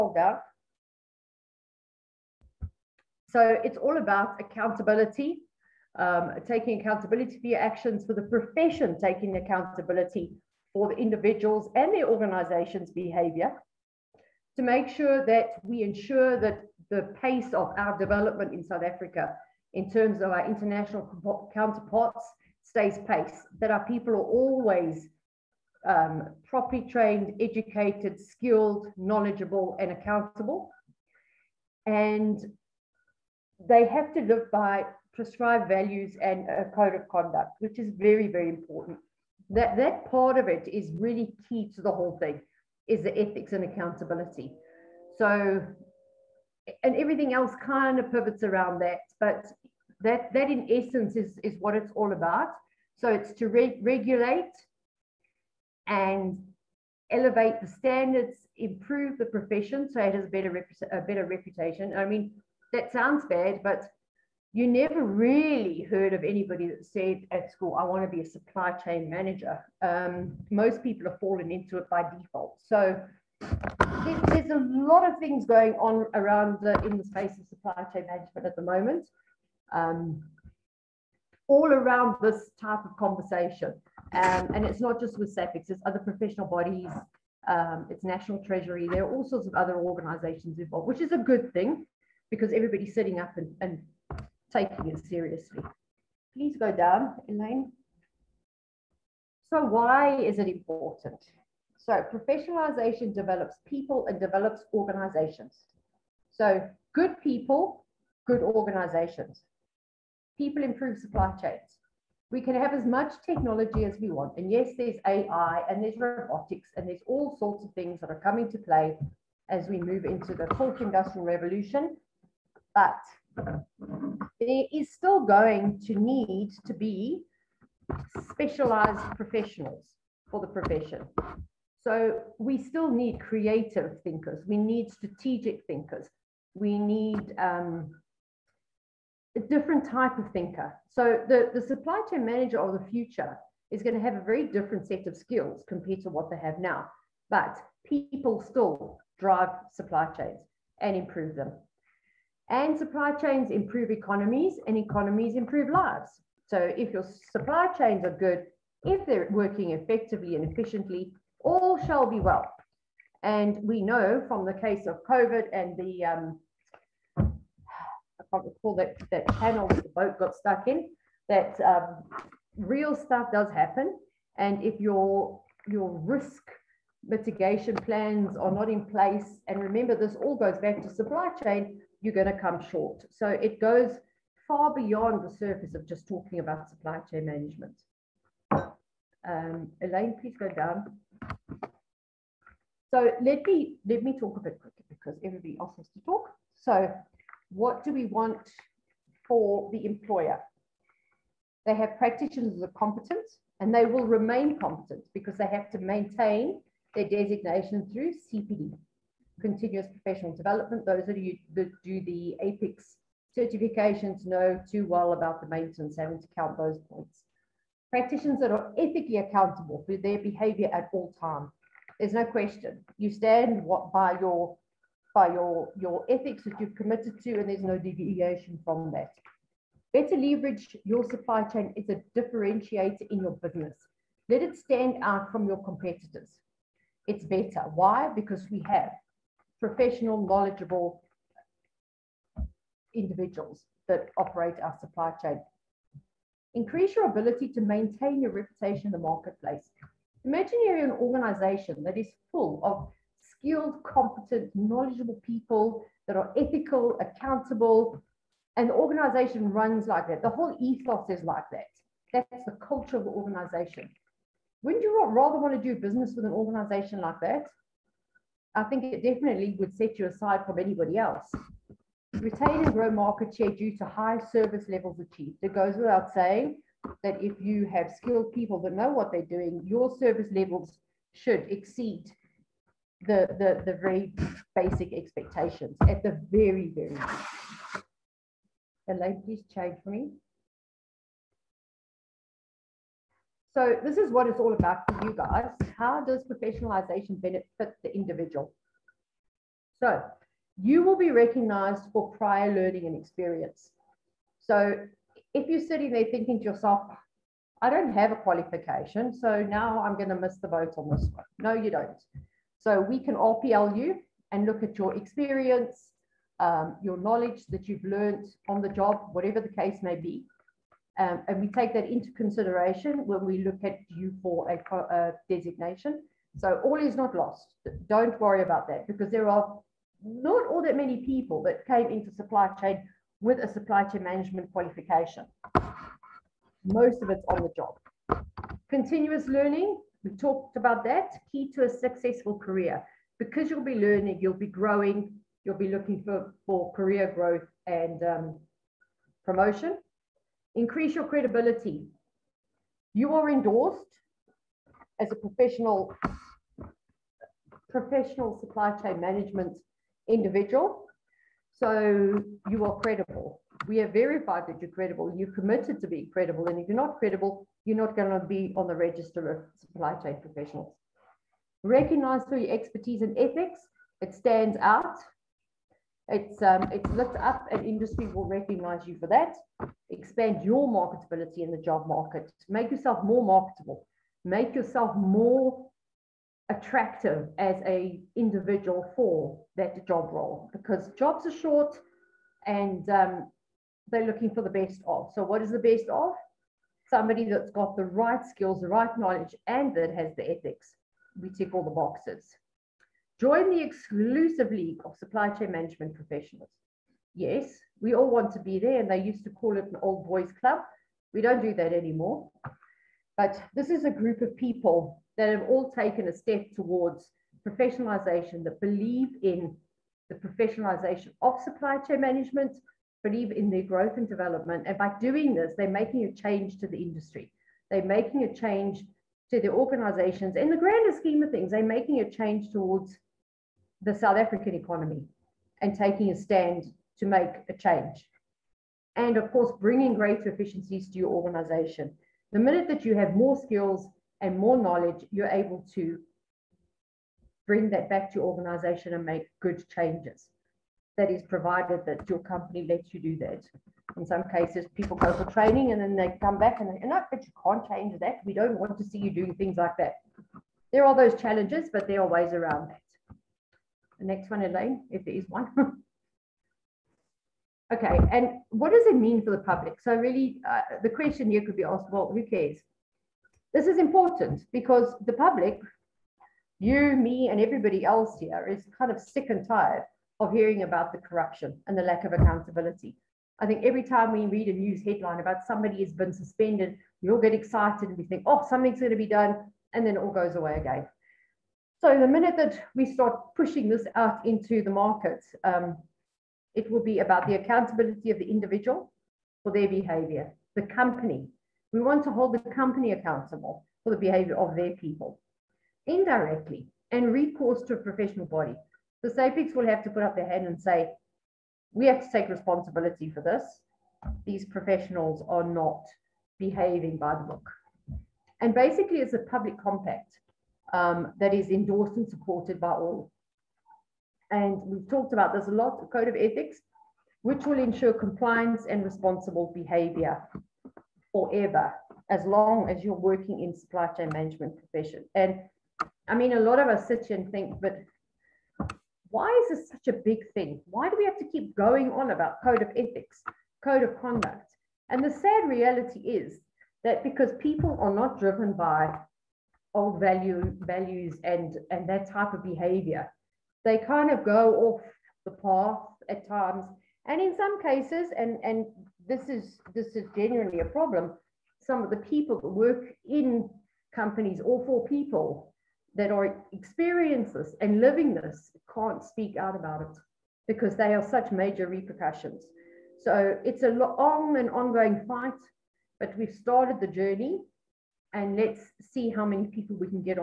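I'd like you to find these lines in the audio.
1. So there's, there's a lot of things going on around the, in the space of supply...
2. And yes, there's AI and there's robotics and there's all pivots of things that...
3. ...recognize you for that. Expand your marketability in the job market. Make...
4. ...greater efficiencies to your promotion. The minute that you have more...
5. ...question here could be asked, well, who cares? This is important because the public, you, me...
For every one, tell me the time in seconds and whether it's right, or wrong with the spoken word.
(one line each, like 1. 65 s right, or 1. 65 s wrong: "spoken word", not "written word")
1. 72 s right
2. 114 s wrong: "sorts", not "pivots"
3. 378 s right
4. 439 s wrong: "organization", not "promotion"
5. 470 s right.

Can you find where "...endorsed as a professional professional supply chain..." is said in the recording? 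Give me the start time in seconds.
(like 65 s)
353 s.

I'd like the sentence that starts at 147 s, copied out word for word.
But people still drive supply chains and improve them.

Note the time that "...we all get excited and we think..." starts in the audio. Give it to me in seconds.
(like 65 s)
487 s.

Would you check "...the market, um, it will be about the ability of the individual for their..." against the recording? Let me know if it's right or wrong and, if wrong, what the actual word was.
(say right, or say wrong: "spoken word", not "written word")
wrong: "accountability", not "ability".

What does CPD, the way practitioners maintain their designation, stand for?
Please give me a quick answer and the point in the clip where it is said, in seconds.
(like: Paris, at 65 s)
continuous professional development, at 209 s.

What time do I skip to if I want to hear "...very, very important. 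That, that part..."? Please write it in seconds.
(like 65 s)
37 s.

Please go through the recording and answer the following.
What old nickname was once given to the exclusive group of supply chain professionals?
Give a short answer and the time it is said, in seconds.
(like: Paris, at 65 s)
old boys club, at 409 s.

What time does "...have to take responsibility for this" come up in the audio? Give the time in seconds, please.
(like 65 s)
511 s.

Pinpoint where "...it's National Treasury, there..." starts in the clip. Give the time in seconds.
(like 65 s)
87 s.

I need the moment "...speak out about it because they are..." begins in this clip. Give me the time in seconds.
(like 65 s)
569 s.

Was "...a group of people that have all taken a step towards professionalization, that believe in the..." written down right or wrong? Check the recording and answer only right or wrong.
right.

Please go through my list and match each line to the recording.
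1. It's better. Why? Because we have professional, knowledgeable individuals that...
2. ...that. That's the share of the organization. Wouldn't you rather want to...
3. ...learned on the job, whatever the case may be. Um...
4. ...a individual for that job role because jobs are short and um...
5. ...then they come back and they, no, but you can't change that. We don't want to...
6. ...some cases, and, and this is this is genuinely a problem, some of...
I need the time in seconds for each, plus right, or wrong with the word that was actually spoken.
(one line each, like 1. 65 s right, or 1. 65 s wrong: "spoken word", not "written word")
1. 237 s right
2. 261 s wrong: "culture", not "share"
3. 317 s right
4. 387 s right
5. 455 s right
6. 557 s right.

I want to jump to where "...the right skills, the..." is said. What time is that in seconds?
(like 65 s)
397 s.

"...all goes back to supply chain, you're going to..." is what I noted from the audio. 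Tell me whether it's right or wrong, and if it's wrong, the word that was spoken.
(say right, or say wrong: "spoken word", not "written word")
right.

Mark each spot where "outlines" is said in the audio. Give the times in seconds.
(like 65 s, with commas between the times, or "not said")
not said.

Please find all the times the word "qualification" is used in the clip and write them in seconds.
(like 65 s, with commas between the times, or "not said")
308 s, 334 s.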